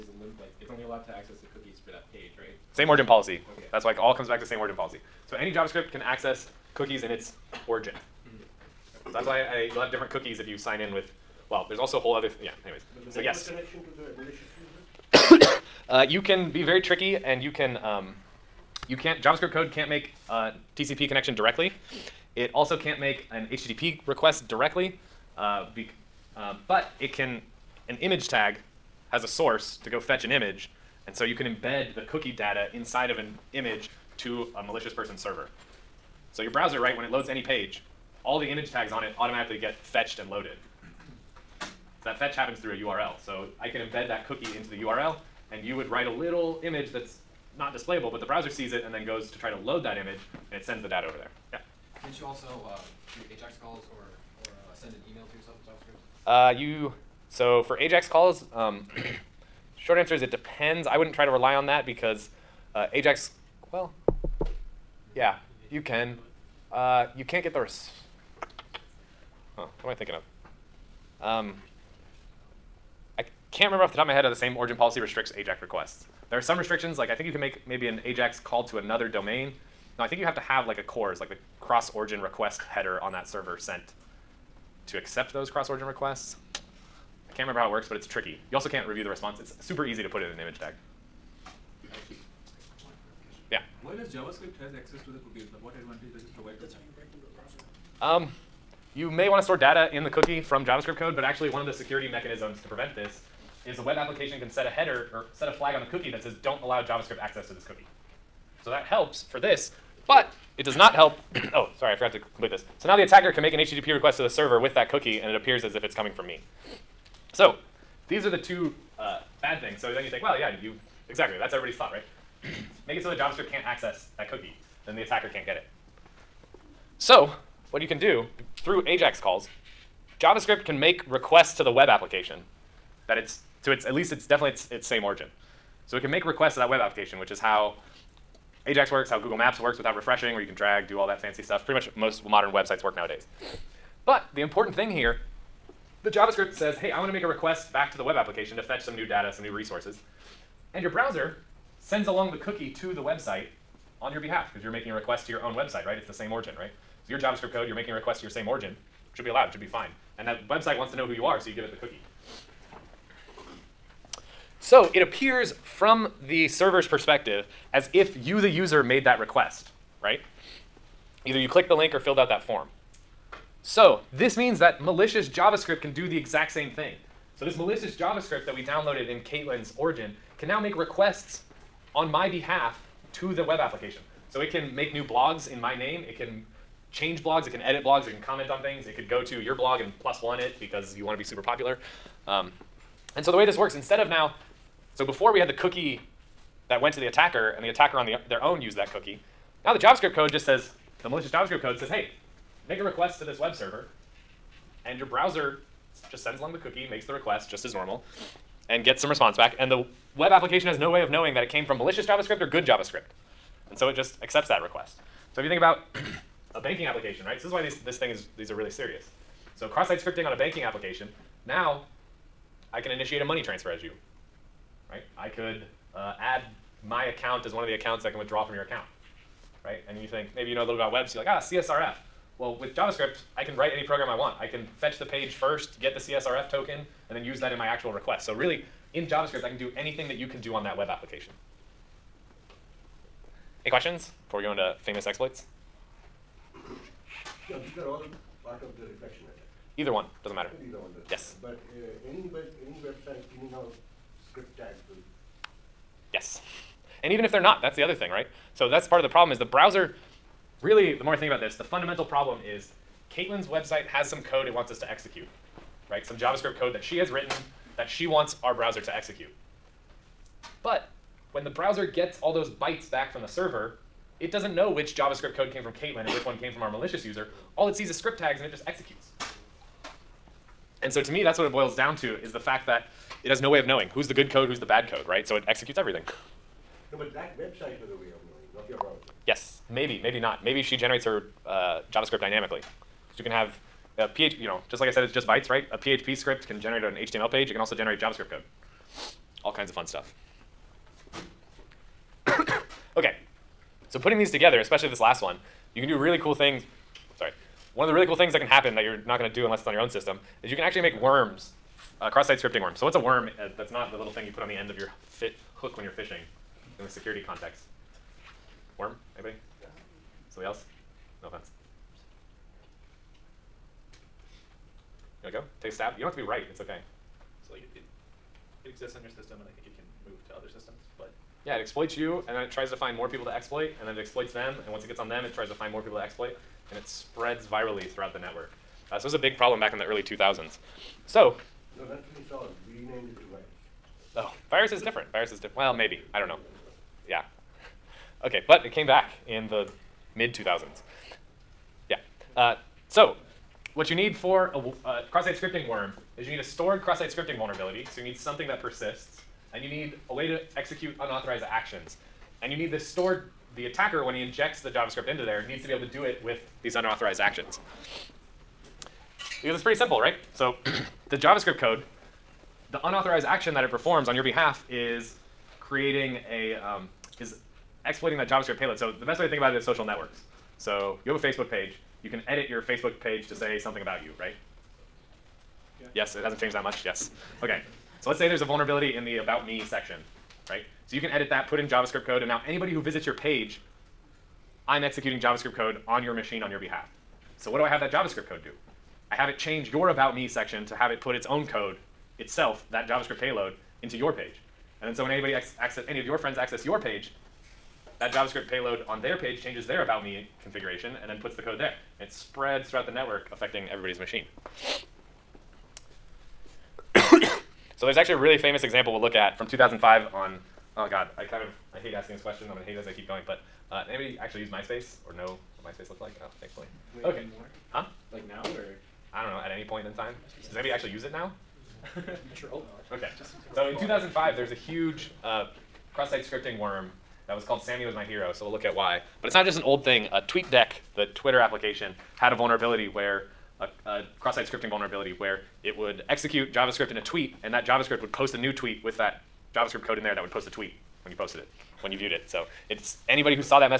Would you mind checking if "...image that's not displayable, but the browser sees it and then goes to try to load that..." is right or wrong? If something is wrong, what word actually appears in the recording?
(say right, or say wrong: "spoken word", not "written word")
right.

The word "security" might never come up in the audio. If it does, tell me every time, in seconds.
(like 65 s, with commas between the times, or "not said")
101 s, 316 s.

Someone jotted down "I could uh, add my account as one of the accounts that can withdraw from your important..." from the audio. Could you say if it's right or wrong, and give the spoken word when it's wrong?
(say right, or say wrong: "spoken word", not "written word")
wrong: "account", not "important".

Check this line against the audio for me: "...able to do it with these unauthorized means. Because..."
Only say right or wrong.
wrong.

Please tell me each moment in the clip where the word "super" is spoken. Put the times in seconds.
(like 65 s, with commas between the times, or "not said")
89 s, 191 s.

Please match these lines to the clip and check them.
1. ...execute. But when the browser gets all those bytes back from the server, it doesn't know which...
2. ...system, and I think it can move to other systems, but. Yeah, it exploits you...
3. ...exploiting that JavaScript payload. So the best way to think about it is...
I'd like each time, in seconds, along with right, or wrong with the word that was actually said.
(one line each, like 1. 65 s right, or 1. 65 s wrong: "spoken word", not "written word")
1. 268 s right
2. 329 s right
3. 377 s right.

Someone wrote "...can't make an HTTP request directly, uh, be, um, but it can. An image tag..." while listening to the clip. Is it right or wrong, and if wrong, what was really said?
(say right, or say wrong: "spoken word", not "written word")
right.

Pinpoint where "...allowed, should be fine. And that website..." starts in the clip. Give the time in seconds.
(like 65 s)
159 s.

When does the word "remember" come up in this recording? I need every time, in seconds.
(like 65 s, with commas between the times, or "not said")
73 s, 87 s.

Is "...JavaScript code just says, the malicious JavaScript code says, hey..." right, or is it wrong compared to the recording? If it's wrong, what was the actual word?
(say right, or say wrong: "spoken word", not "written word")
right.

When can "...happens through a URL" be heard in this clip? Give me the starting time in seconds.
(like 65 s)
42 s.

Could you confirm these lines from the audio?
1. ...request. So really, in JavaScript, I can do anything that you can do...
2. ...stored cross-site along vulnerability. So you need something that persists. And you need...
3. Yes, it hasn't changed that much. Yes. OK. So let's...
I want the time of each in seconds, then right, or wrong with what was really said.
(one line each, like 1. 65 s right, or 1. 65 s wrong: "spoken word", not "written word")
1. 237 s right
2. 356 s wrong: "scripting", not "along"
3. 385 s right.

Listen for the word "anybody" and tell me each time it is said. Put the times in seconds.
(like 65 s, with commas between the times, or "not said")
319 s, 392 s, 405 s, 423 s, 430 s, 453 s.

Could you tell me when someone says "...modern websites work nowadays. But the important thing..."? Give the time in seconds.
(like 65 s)
142 s.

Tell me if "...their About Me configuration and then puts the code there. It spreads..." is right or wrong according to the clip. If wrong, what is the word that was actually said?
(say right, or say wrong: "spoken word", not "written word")
right.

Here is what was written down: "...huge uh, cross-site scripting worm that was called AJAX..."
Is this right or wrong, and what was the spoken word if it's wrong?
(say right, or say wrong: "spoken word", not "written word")
wrong: "Samy", not "AJAX".